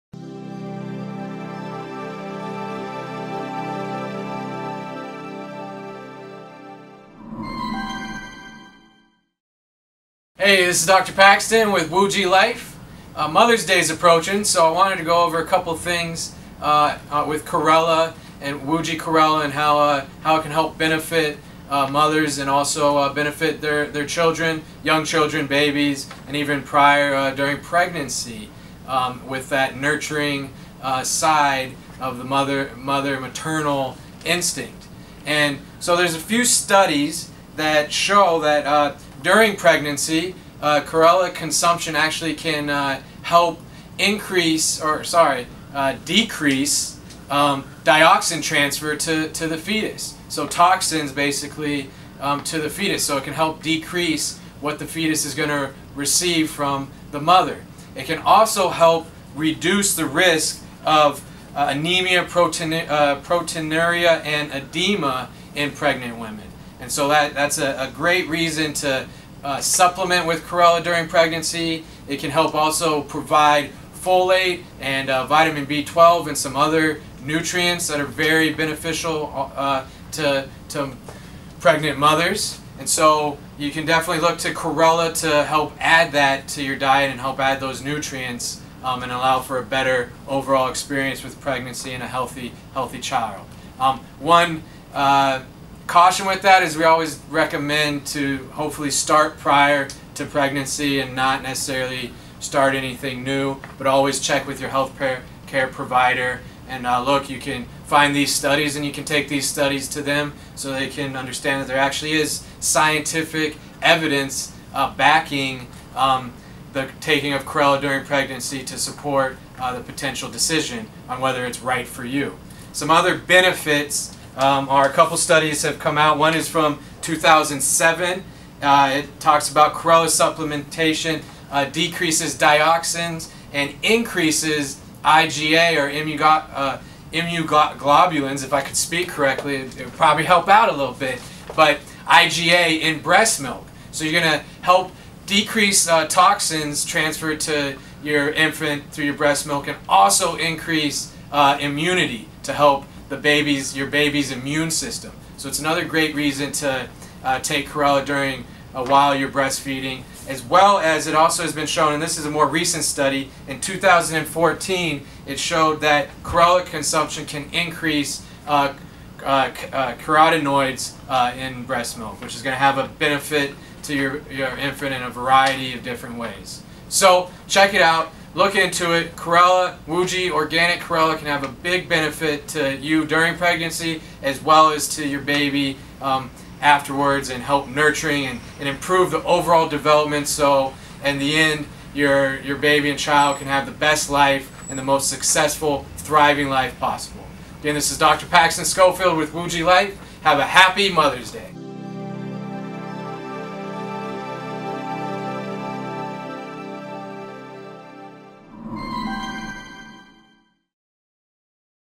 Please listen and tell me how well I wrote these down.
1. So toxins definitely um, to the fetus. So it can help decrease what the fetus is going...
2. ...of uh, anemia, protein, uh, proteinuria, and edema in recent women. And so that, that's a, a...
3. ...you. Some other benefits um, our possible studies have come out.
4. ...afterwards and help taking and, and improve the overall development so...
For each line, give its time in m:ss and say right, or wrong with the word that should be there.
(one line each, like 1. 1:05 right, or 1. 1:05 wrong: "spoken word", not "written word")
1. 0:50 wrong: "basically", not "definitely"
2. 1:00 wrong: "pregnant", not "recent"
3. 2:02 wrong: "couple", not "possible"
4. 3:06 wrong: "nurturing", not "taking".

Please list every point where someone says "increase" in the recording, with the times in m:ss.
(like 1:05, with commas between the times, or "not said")
0:43, 2:13, 2:30, 2:47.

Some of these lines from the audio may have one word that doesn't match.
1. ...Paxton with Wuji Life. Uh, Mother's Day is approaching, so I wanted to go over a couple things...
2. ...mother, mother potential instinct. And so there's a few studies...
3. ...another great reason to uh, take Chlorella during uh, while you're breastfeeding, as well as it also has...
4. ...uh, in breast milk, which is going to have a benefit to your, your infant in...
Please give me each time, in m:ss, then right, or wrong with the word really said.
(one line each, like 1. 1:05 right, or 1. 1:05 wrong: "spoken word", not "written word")
1. 0:11 right
2. 0:32 wrong: "maternal", not "potential"
3. 2:35 right
4. 2:51 right.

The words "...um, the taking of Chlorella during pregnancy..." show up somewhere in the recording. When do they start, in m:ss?
1:55.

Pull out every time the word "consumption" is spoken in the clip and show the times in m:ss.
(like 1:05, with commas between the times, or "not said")
0:41, 2:46.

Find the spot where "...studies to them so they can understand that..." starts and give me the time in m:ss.
1:49.